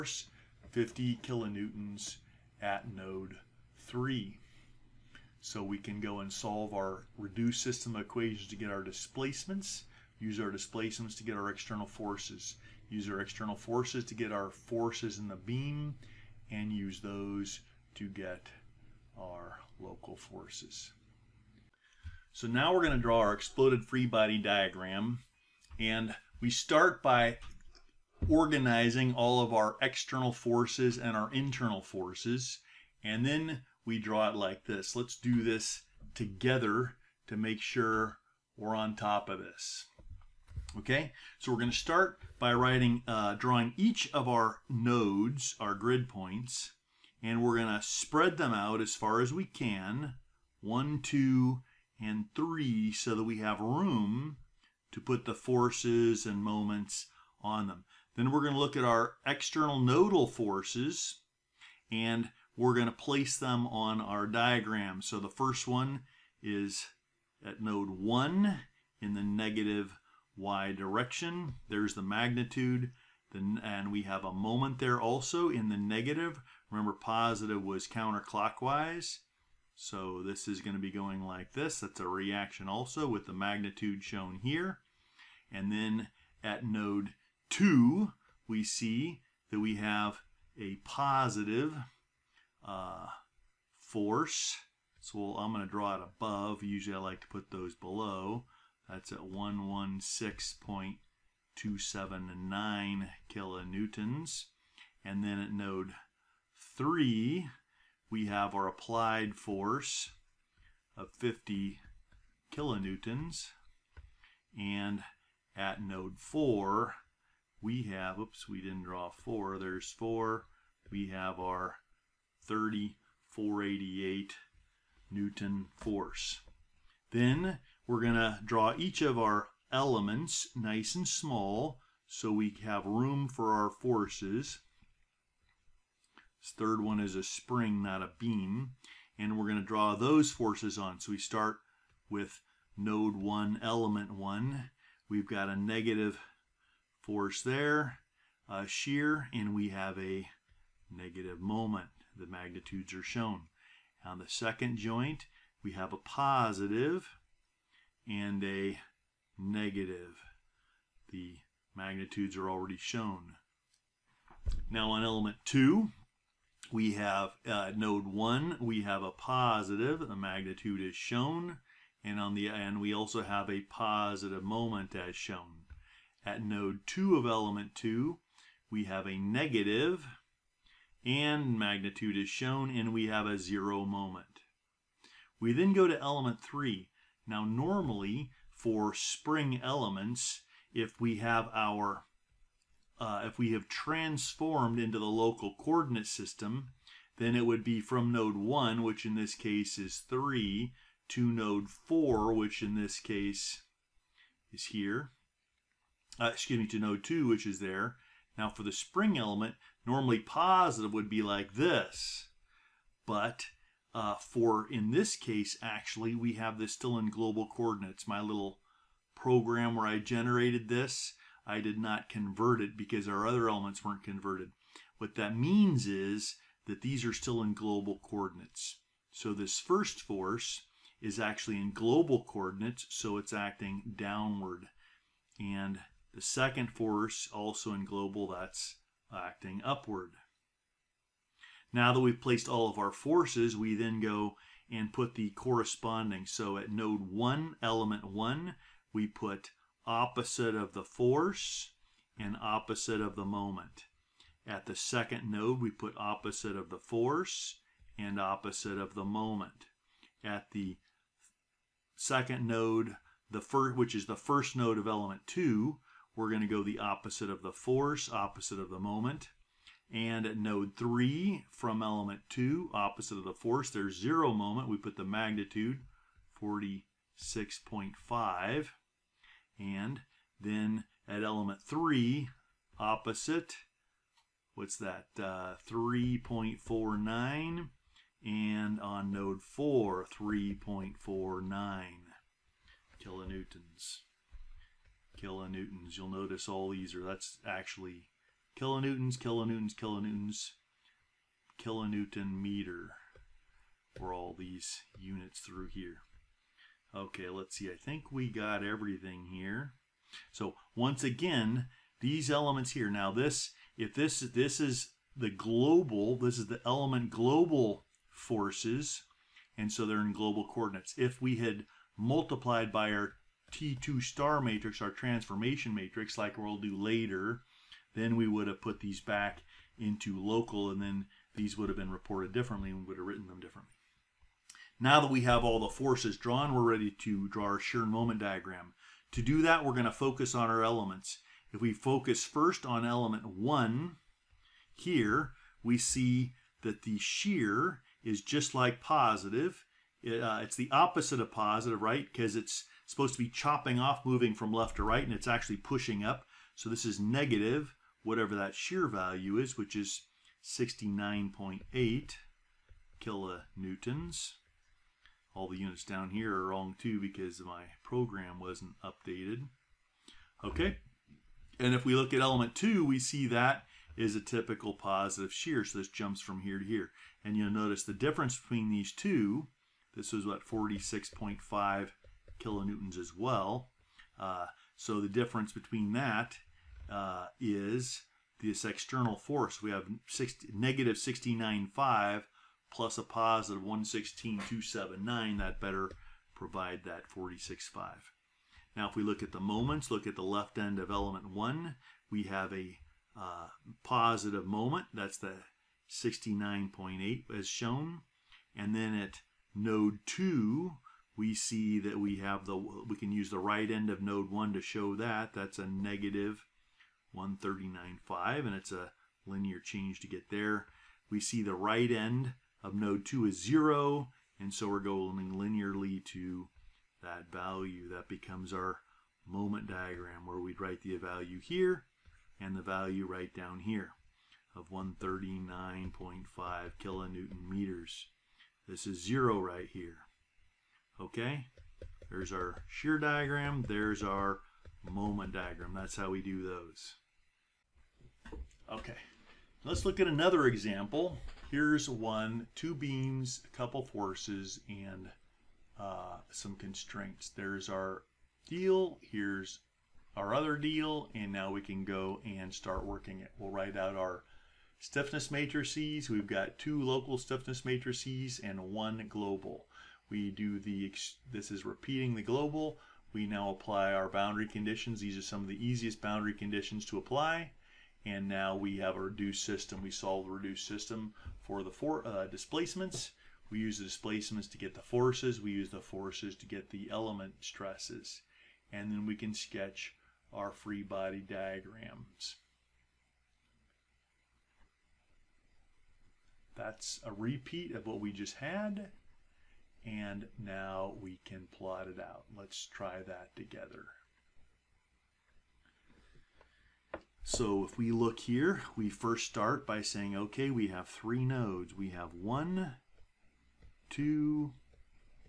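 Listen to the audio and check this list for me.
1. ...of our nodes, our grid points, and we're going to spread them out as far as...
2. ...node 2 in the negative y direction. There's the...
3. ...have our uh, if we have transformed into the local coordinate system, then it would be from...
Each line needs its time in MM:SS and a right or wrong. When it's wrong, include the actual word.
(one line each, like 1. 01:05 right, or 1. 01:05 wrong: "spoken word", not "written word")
1. 00:44 right
2. 01:07 wrong: "1", not "2"
3. 03:11 right.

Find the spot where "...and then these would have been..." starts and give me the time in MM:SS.
05:30.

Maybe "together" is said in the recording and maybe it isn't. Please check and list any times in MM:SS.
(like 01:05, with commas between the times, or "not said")
00:36, 08:23.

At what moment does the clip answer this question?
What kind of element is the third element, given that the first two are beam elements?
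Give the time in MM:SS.
02:17.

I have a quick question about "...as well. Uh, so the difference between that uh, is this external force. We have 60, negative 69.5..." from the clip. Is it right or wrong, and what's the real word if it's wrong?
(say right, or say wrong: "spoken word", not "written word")
right.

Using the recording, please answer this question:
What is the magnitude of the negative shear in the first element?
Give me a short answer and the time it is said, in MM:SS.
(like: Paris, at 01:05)
69.8 kilonewtons, at 06:00.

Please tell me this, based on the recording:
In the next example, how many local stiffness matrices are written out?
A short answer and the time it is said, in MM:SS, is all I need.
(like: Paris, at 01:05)
2, at 07:46.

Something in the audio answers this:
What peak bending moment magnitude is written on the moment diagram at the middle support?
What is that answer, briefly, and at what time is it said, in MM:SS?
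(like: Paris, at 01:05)
139.5 kilonewton meters, at 07:14.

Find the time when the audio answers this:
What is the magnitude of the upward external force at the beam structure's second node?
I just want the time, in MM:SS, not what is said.
01:39.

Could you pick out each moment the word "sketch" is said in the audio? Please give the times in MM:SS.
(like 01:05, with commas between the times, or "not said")
08:09.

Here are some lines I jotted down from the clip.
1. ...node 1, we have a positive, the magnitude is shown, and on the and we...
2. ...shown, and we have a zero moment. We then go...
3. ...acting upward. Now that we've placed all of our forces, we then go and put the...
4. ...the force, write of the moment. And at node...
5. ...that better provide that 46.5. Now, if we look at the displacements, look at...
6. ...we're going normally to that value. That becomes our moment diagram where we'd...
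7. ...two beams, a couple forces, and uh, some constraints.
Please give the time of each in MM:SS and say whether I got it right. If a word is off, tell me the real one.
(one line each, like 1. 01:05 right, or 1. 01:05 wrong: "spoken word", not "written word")
1. 02:47 right
2. 03:02 right
3. 03:59 right
4. 04:27 wrong: "opposite", not "write"
5. 06:35 wrong: "moments", not "displacements"
6. 07:04 wrong: "linearly", not "normally"
7. 07:32 right.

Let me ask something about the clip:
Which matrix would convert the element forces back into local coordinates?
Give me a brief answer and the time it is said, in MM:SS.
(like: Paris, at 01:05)
T2 star matrix, at 05:23.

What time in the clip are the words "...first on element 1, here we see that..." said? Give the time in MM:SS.
05:42.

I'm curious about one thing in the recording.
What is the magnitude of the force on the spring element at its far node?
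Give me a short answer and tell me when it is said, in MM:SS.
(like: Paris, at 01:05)
3.49 kilonewtons, at 04:50.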